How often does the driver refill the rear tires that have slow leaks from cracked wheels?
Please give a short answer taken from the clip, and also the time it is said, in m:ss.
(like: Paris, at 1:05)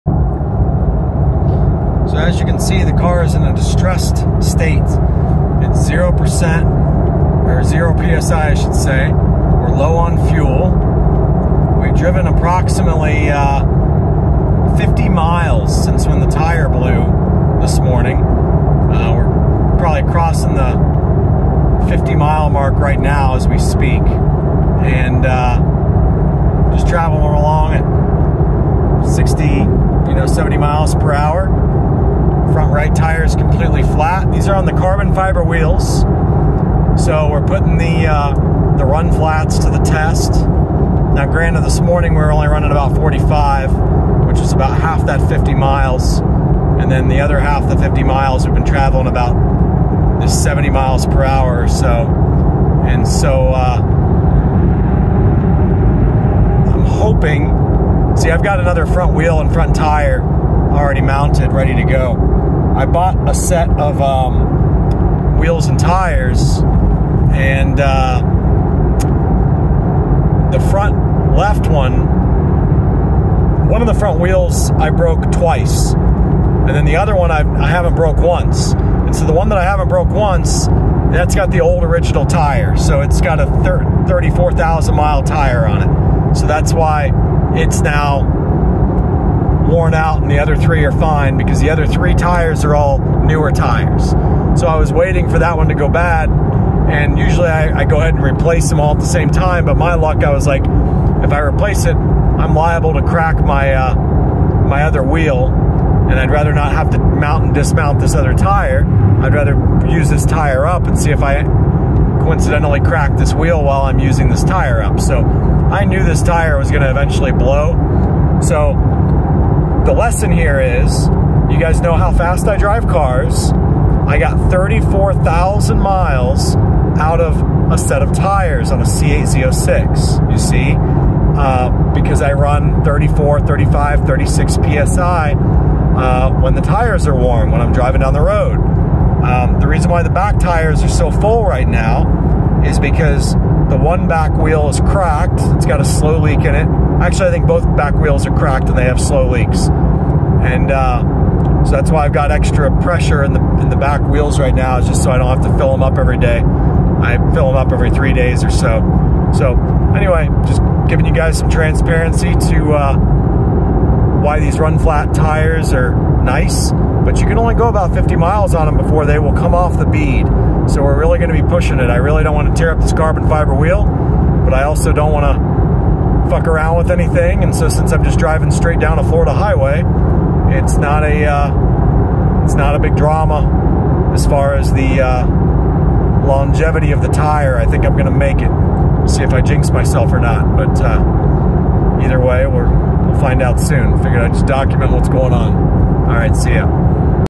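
Every 3 days, at 2:37.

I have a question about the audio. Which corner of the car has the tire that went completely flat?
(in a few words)
Front right.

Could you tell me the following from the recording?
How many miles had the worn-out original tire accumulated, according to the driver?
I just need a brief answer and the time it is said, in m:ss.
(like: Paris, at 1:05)
34,000, at 1:24.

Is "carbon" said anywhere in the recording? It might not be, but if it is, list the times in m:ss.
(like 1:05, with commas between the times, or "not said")
0:34, 2:52.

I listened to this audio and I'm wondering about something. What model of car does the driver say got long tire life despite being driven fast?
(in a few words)
C8 Z06.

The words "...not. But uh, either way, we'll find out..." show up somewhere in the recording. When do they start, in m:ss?
3:10.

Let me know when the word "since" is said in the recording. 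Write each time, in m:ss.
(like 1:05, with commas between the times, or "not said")
0:15, 2:57.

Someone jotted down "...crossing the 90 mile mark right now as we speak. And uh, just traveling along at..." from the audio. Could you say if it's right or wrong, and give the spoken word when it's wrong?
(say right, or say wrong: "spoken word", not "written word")
wrong: "50", not "90".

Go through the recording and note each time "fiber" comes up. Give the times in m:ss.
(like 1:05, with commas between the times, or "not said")
0:35, 2:53.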